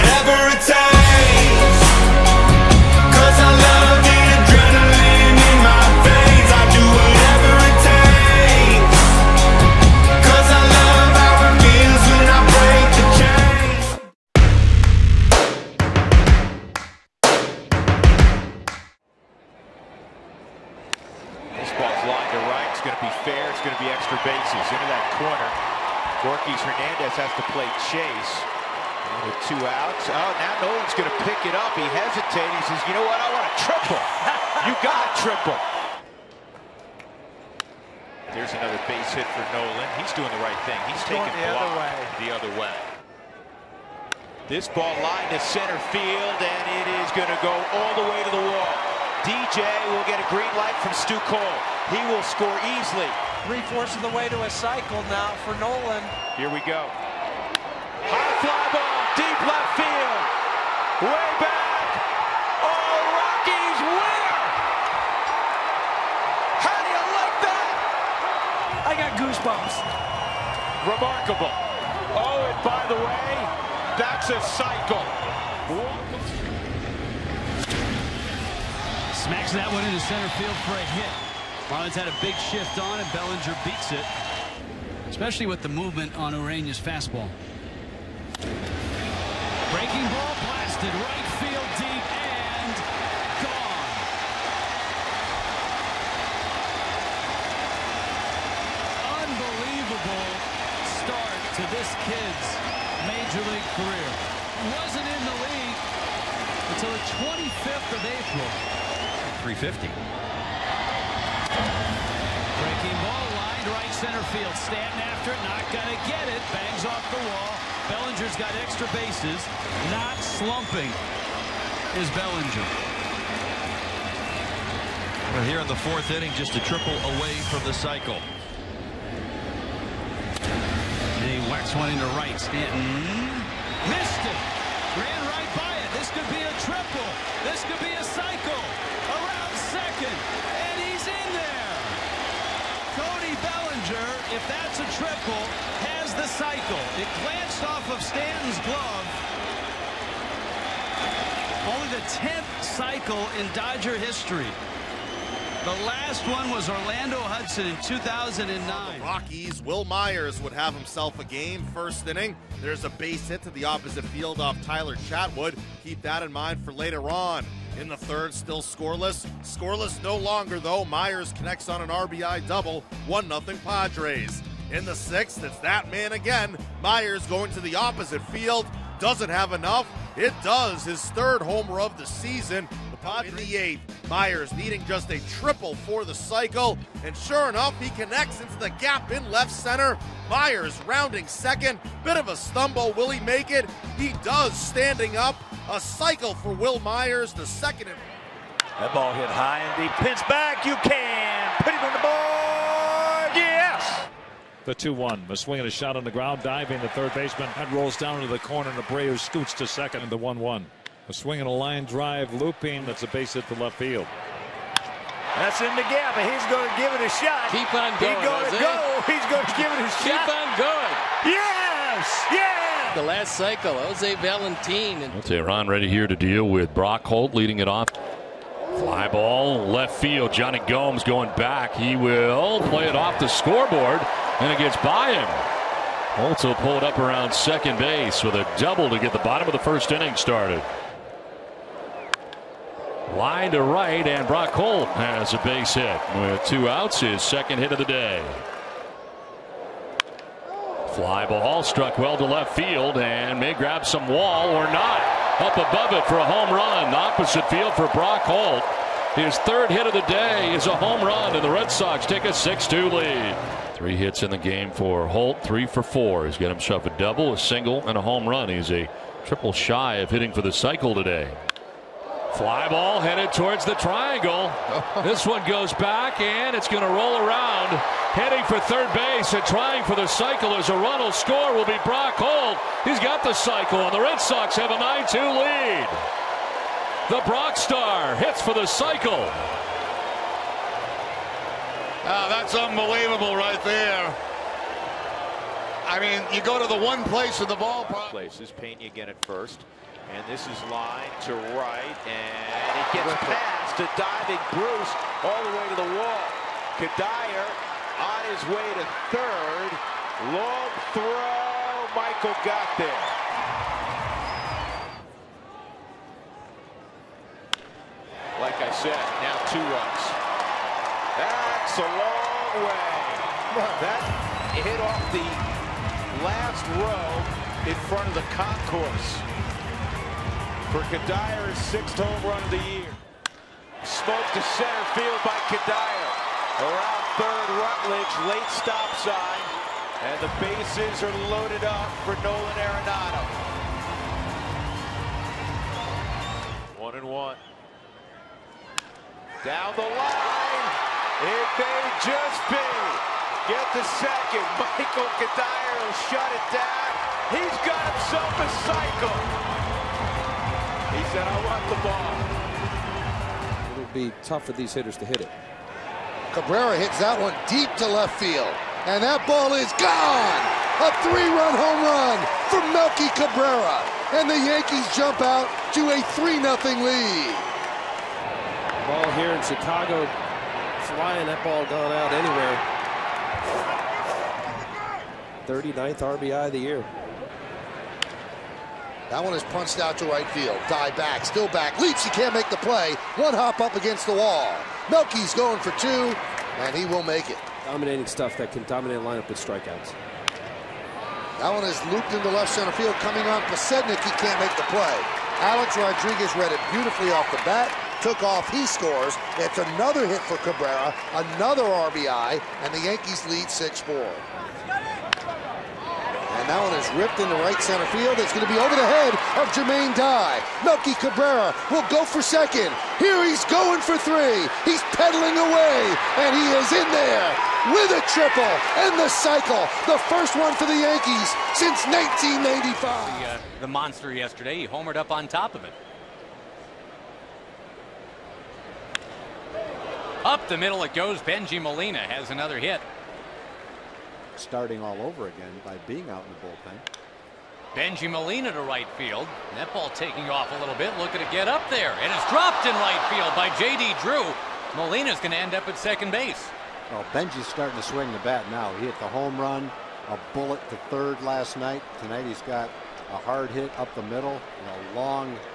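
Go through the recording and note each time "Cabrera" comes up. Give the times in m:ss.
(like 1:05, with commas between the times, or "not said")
6:06, 6:13, 6:50, 7:01.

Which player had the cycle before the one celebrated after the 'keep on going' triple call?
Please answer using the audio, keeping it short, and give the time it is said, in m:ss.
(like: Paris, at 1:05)
Jose Valentin, at 3:43.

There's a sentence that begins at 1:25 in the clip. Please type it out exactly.
Especially with the movement on Urena's fastball.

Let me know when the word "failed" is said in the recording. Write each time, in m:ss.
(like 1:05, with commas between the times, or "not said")
not said.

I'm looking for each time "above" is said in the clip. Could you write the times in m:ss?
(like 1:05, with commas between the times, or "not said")
4:15.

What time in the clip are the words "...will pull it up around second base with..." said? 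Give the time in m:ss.
3:56.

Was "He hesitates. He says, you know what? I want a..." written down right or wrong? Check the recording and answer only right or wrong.
right.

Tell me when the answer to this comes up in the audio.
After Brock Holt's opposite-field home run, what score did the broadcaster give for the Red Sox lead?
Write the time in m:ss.
4:22.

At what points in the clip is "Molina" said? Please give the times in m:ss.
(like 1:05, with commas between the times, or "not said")
7:21, 7:28, 7:34.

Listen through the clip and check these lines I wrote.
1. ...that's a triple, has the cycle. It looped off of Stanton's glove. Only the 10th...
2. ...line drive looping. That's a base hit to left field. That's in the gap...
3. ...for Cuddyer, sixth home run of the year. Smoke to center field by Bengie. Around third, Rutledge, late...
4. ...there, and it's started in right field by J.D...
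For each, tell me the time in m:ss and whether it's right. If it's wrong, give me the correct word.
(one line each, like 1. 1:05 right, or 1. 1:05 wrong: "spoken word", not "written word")
1. 2:24 wrong: "glanced", not "looped"
2. 3:31 right
3. 5:30 wrong: "Cuddyer", not "Bengie"
4. 7:31 wrong: "dropped", not "started".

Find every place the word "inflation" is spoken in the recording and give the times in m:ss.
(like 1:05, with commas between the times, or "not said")
not said.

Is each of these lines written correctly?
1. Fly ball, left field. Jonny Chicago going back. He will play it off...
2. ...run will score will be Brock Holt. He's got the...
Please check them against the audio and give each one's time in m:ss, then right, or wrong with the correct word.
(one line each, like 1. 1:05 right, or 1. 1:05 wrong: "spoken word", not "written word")
1. 3:48 wrong: "Gomes", not "Chicago"
2. 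4:40 right.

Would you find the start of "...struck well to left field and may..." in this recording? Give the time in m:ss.
4:11.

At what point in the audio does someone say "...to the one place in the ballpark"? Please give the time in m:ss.
4:56.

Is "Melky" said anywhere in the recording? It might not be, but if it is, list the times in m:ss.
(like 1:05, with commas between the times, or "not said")
6:12, 6:34, 7:00.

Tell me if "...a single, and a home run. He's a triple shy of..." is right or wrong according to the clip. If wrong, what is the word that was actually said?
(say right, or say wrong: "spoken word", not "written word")
right.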